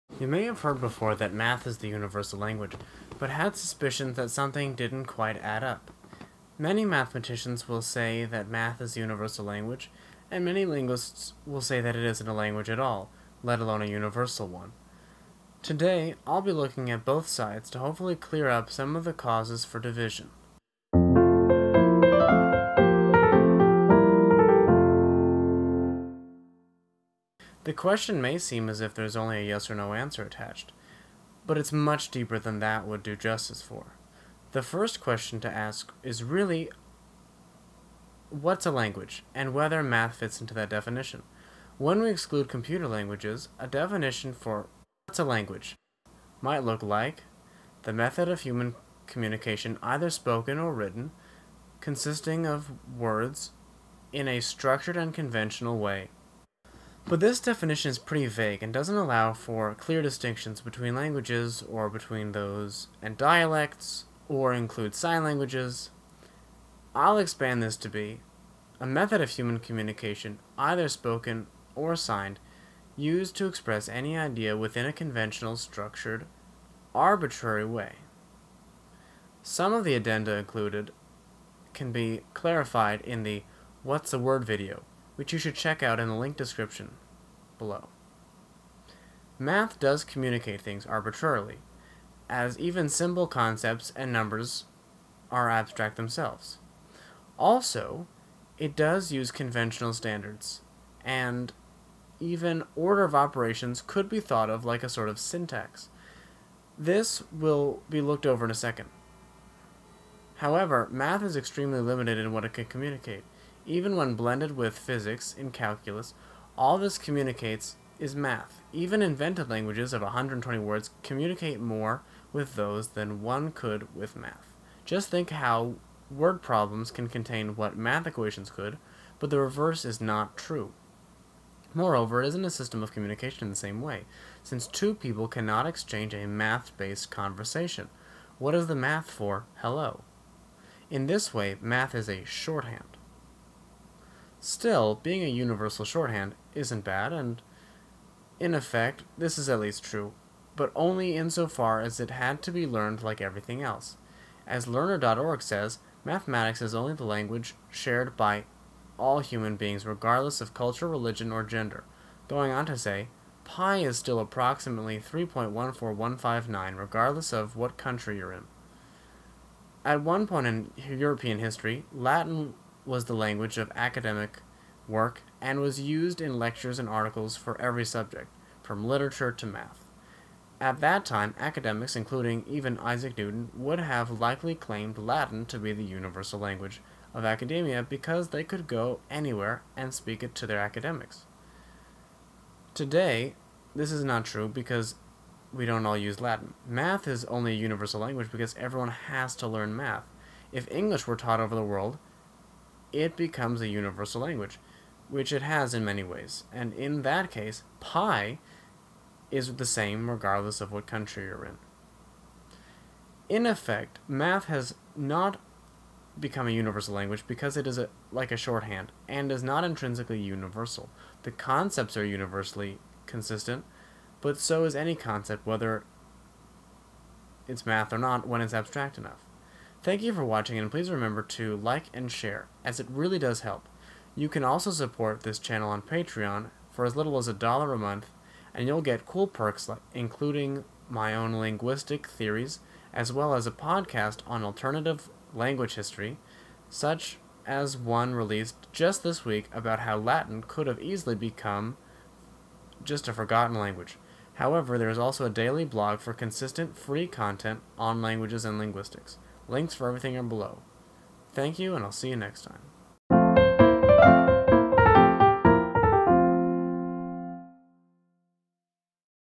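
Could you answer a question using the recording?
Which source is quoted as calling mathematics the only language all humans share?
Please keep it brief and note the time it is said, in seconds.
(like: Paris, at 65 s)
Learner.org, at 154 s.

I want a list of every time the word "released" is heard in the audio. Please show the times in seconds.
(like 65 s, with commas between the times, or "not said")
248 s.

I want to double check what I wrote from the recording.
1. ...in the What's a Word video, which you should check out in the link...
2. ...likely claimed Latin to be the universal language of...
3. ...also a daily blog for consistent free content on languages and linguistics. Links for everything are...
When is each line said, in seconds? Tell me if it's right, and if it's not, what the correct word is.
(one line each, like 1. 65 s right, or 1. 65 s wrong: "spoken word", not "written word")
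1. 83 s right
2. 184 s right
3. 254 s right.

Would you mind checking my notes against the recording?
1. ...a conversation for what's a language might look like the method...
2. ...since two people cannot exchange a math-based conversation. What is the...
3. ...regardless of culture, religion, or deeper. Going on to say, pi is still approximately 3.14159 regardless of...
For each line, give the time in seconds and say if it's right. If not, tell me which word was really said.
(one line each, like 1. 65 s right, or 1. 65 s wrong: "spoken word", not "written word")
1. 43 s wrong: "definition", not "conversation"
2. 134 s right
3. 159 s wrong: "gender", not "deeper".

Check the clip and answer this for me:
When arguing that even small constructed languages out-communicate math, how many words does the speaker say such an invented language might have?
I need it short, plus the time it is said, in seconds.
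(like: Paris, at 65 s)
120, at 120 s.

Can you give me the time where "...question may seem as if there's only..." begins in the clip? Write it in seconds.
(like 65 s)
27 s.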